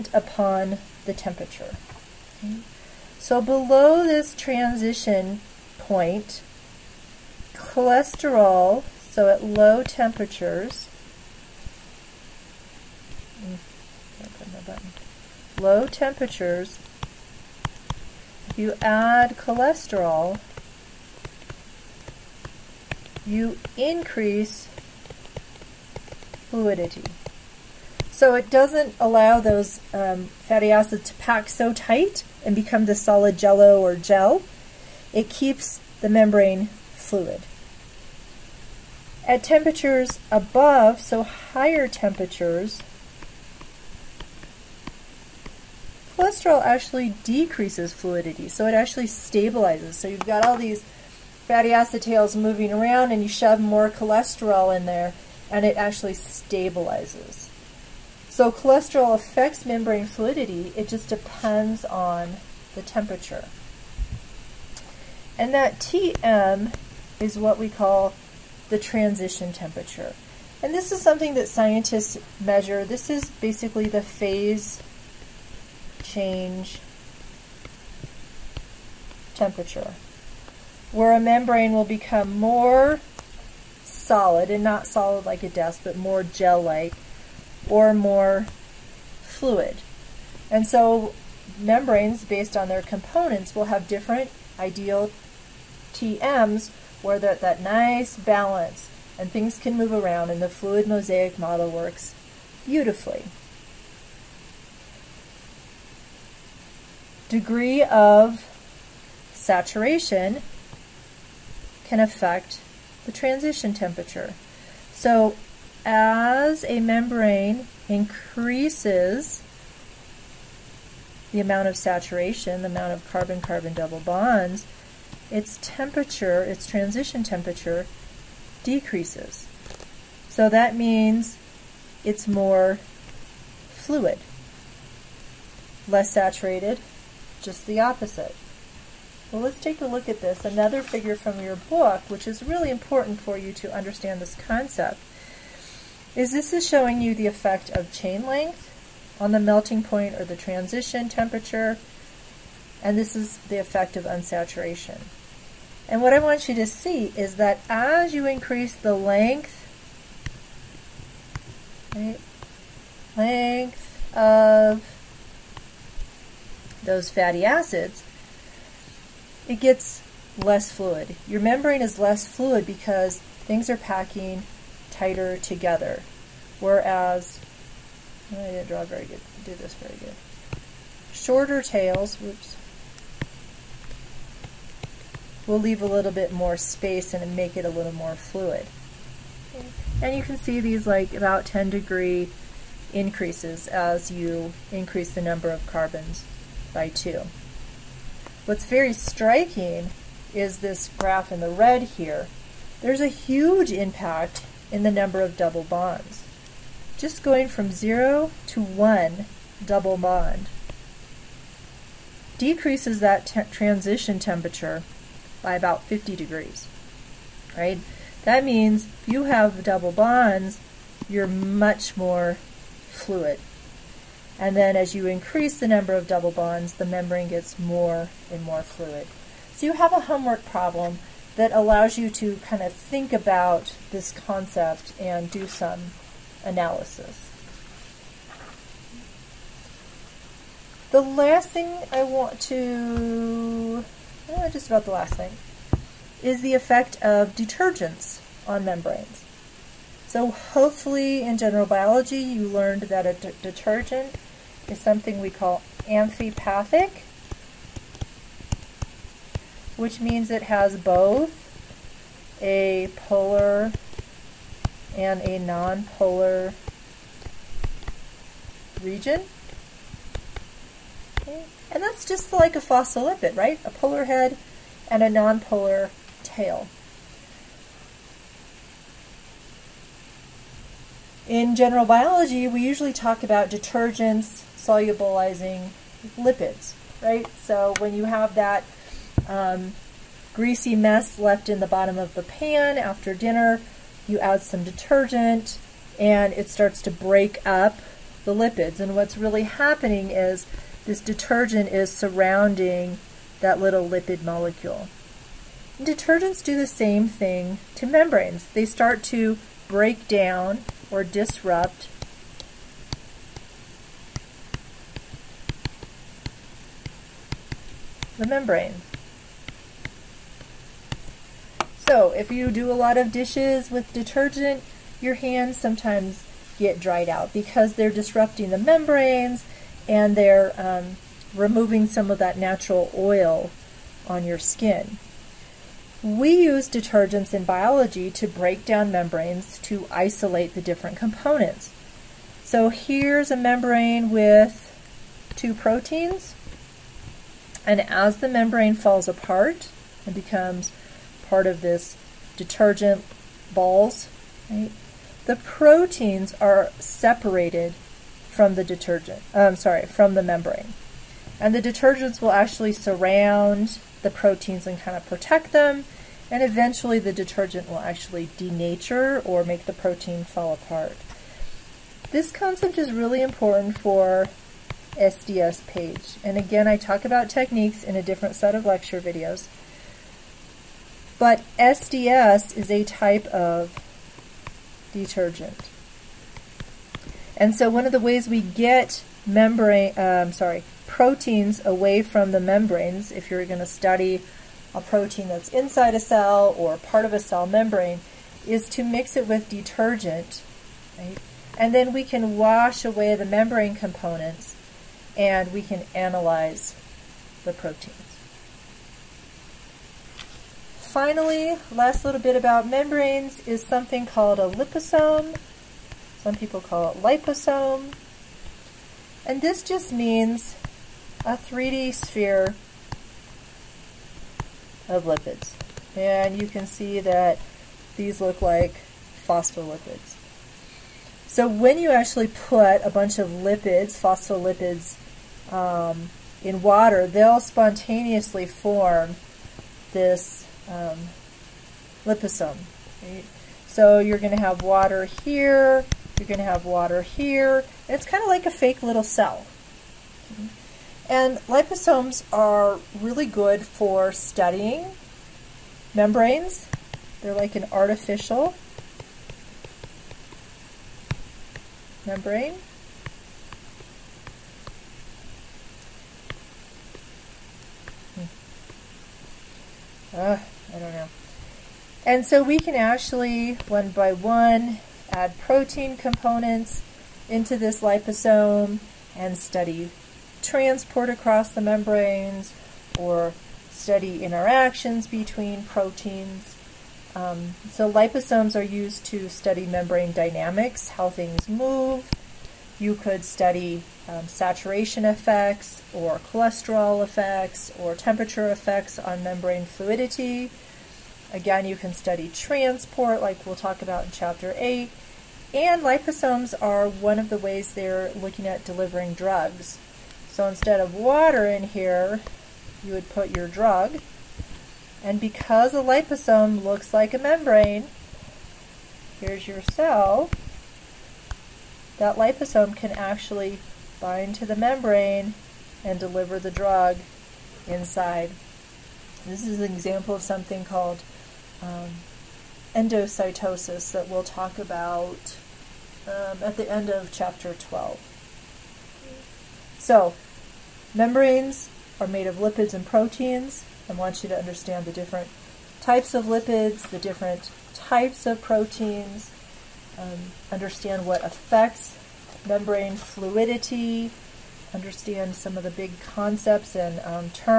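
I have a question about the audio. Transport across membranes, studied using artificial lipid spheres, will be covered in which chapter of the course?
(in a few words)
chapter 8.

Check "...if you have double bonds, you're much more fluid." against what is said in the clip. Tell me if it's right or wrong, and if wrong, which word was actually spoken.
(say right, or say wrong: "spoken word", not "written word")
right.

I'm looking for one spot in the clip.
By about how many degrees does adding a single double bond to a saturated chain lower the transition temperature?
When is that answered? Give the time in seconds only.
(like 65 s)
215 s.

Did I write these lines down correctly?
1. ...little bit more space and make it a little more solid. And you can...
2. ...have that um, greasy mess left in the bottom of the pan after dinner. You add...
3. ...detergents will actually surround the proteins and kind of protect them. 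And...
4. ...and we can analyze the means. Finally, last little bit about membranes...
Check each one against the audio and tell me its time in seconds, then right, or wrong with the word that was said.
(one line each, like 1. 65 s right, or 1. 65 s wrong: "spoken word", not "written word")
1. 185 s wrong: "fluid", not "solid"
2. 288 s right
3. 361 s right
4. 405 s wrong: "proteins", not "means".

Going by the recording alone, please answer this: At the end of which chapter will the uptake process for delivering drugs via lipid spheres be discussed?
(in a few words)
chapter 12.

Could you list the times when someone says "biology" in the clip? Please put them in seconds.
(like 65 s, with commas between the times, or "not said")
251 s, 281 s, 337 s.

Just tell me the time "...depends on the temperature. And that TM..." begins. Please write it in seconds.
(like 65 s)
61 s.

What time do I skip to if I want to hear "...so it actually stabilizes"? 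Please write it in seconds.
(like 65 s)
48 s.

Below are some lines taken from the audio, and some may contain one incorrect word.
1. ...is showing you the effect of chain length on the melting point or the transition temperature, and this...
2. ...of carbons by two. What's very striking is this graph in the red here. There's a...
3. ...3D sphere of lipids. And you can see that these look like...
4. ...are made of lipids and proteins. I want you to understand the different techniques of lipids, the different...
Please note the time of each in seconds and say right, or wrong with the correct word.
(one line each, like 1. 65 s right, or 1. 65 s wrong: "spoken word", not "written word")
1. 146 s right
2. 195 s right
3. 421 s right
4. 542 s wrong: "types", not "techniques".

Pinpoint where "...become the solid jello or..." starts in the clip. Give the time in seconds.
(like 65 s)
32 s.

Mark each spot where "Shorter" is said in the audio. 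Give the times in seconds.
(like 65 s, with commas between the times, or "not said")
181 s.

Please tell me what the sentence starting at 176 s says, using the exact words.
Whereas, I didn't draw very good, do this very good.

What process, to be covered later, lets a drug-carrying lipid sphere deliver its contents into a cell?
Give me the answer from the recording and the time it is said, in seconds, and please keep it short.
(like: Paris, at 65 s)
endocytosis, at 532 s.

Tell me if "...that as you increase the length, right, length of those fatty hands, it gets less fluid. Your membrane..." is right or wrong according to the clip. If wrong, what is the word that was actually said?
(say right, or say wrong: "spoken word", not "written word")
wrong: "acids", not "hands".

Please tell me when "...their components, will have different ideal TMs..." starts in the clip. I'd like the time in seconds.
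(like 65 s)
92 s.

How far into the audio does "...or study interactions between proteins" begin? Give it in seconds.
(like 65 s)
482 s.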